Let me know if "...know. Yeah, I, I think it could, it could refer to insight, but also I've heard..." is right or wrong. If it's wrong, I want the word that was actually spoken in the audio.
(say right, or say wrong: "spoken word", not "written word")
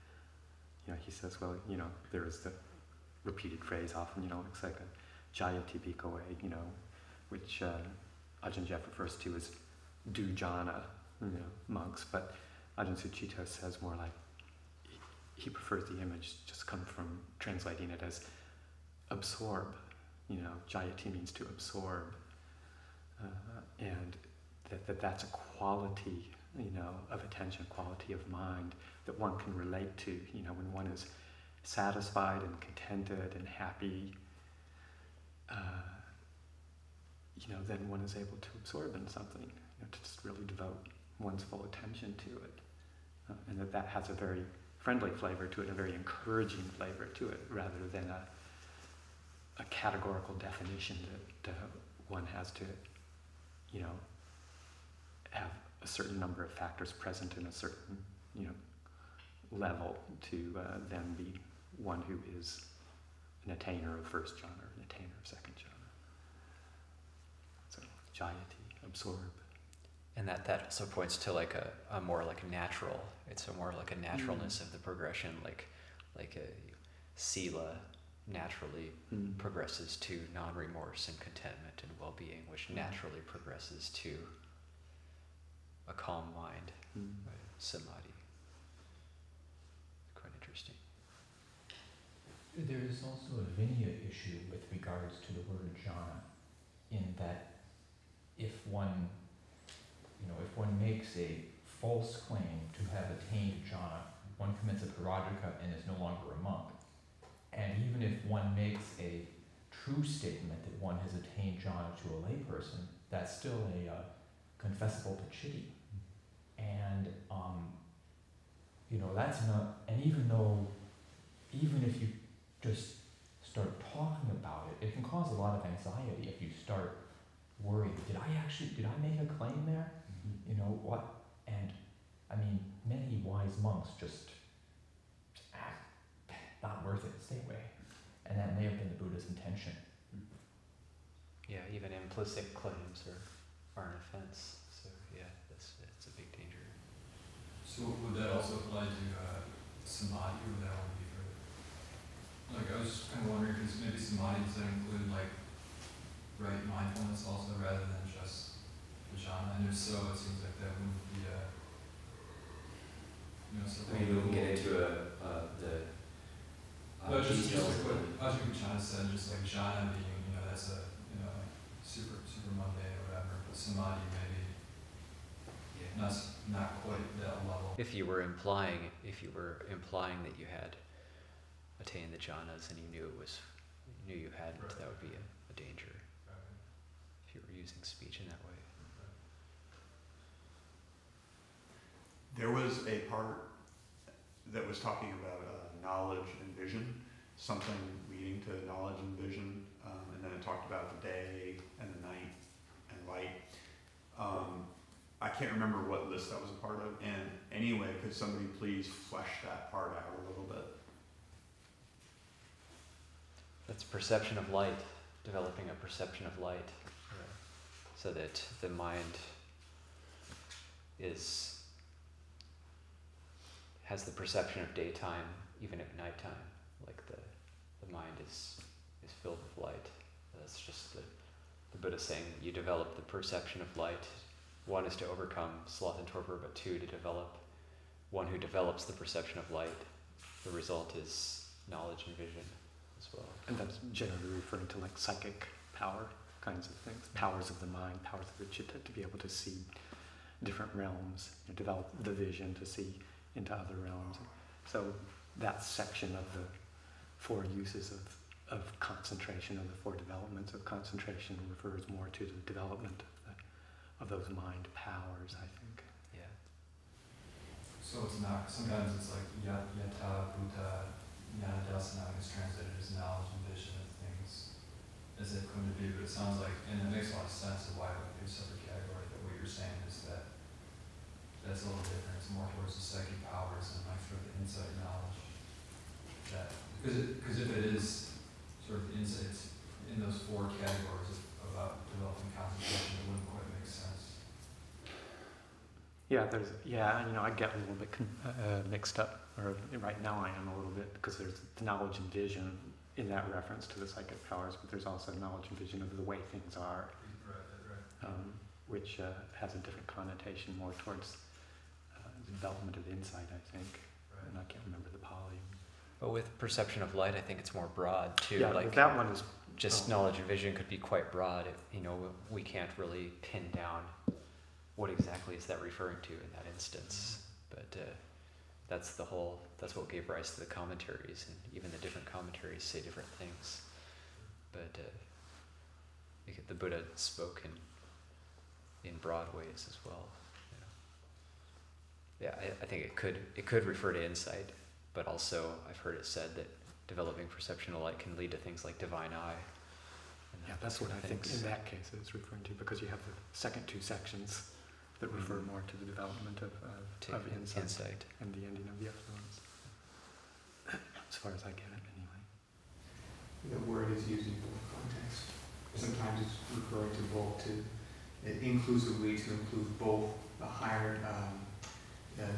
right.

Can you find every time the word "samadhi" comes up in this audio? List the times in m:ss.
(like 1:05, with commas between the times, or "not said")
1:27, 2:29, 2:33, 2:53.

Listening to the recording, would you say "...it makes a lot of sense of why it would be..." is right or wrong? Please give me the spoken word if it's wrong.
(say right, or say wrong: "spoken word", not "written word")
right.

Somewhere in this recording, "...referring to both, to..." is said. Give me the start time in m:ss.
6:06.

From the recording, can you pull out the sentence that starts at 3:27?
And anyway, could somebody please flesh that part out a little bit?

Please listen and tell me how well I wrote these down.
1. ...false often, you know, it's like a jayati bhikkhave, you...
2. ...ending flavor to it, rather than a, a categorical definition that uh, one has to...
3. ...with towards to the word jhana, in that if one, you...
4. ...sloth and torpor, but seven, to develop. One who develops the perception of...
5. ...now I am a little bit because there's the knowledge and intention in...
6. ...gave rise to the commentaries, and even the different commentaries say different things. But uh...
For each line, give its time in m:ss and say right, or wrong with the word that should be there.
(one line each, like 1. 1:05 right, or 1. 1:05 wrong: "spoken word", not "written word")
1. 0:03 wrong: "phrase", not "false"
2. 0:45 wrong: "encouraging", not "ending"
3. 1:34 wrong: "regards", not "towards"
4. 3:55 wrong: "two", not "seven"
5. 5:00 wrong: "vision", not "intention"
6. 5:29 right.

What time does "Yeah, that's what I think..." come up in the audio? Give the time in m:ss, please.
5:50.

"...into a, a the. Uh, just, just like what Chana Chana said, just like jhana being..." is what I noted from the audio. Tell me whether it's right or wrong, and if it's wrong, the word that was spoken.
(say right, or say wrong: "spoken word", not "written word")
wrong: "Ajahn", not "Chana".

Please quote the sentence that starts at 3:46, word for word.
Like the the mind is is filled with light.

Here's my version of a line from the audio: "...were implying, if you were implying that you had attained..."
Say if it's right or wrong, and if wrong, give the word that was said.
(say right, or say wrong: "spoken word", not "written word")
right.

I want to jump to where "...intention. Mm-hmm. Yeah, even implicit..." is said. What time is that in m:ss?
2:19.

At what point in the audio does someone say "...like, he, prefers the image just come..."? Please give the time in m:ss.
0:13.